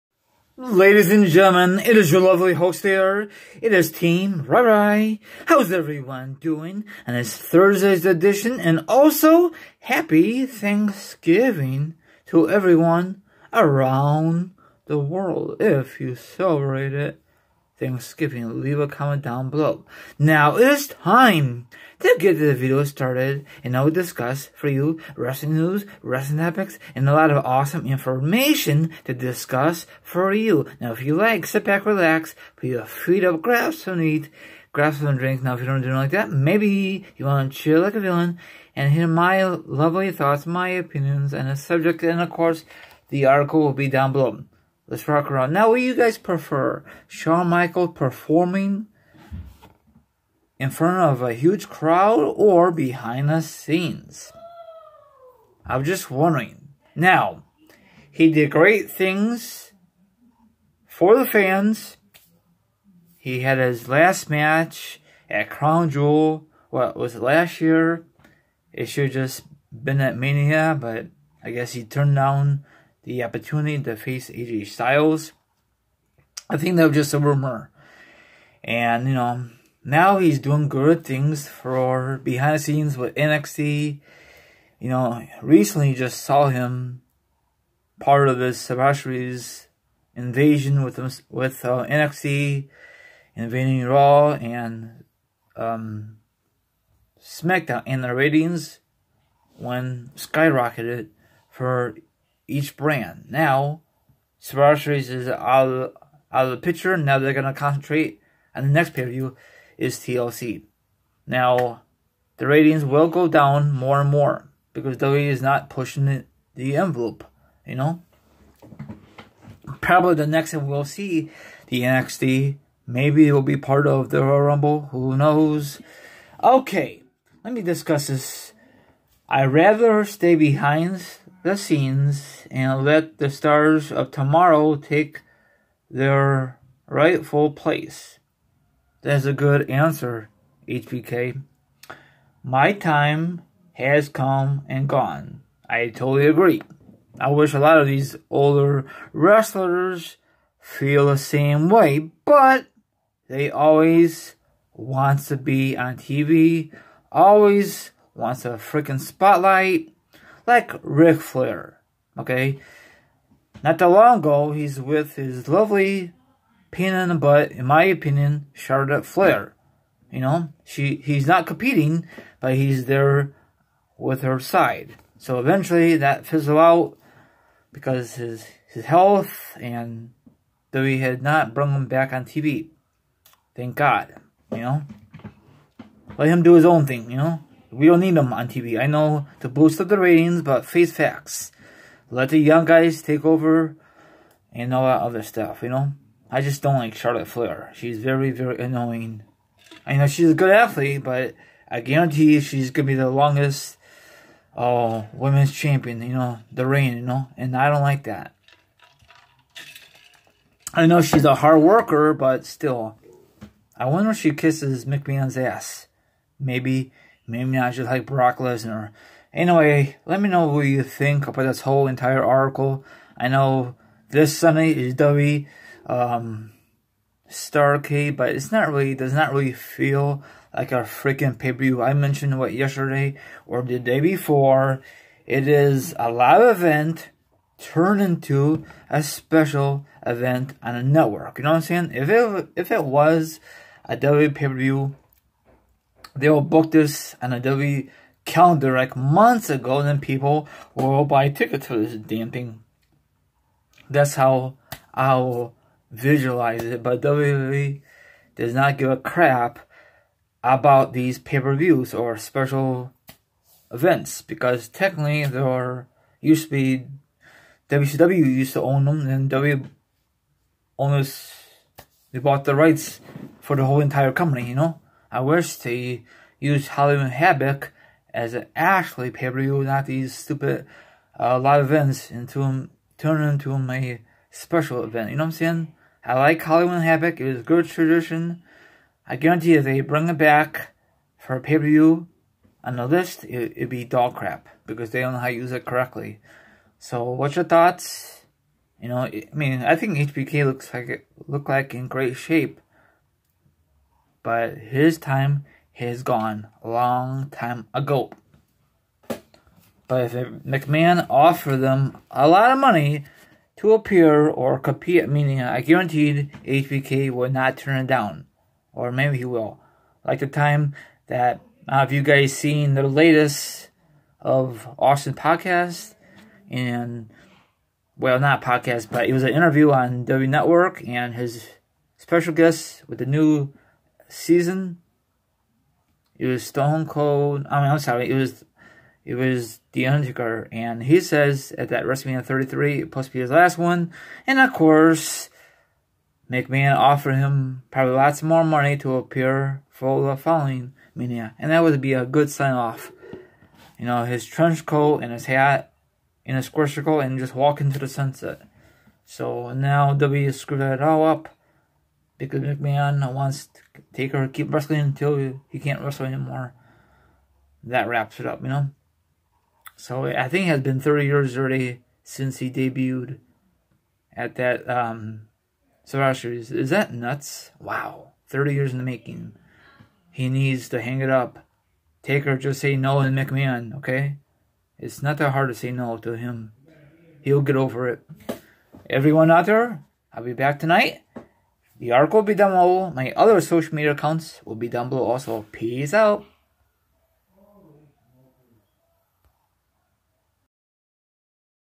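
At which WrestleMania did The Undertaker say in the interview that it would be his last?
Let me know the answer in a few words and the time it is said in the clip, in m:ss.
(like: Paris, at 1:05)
WrestleMania 33, at 5:41.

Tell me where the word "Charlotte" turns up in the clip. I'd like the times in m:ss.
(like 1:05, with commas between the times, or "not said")
2:48, 3:16.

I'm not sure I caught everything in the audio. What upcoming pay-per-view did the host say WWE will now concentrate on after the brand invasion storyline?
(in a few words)
TLC.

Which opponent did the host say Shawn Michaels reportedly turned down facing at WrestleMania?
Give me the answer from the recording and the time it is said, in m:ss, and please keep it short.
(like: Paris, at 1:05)
AJ Styles, at 1:14.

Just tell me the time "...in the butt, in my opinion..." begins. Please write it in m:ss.
2:46.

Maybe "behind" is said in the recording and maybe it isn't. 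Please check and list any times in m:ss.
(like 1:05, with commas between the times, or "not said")
0:52, 1:22, 2:10.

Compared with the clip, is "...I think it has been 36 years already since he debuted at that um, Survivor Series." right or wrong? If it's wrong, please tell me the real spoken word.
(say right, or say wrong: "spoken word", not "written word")
wrong: "30", not "36".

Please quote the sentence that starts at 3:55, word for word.
It is a live event turned into a special event on a network.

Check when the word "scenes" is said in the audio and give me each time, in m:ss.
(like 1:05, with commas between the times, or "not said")
0:53, 1:22, 2:11.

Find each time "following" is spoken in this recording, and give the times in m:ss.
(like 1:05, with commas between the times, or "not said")
5:50.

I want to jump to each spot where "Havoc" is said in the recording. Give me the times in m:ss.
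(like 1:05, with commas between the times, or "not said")
4:37, 4:46.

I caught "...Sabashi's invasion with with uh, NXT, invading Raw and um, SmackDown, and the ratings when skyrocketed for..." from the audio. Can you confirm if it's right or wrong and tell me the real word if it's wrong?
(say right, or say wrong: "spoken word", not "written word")
right.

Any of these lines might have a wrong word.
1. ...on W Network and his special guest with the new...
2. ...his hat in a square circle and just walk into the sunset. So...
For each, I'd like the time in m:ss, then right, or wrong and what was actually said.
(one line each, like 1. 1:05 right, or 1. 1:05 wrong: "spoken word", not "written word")
1. 5:29 right
2. 5:55 right.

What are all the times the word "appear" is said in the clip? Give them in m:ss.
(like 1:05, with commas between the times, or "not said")
5:13, 5:48.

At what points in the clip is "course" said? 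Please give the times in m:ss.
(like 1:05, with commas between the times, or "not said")
0:42, 5:44.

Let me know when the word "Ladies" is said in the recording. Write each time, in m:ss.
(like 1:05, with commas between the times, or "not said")
0:00.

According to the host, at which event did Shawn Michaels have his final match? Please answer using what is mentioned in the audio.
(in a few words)
Crown Jewel.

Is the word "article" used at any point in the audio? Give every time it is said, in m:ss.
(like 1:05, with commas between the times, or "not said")
0:43, 3:42.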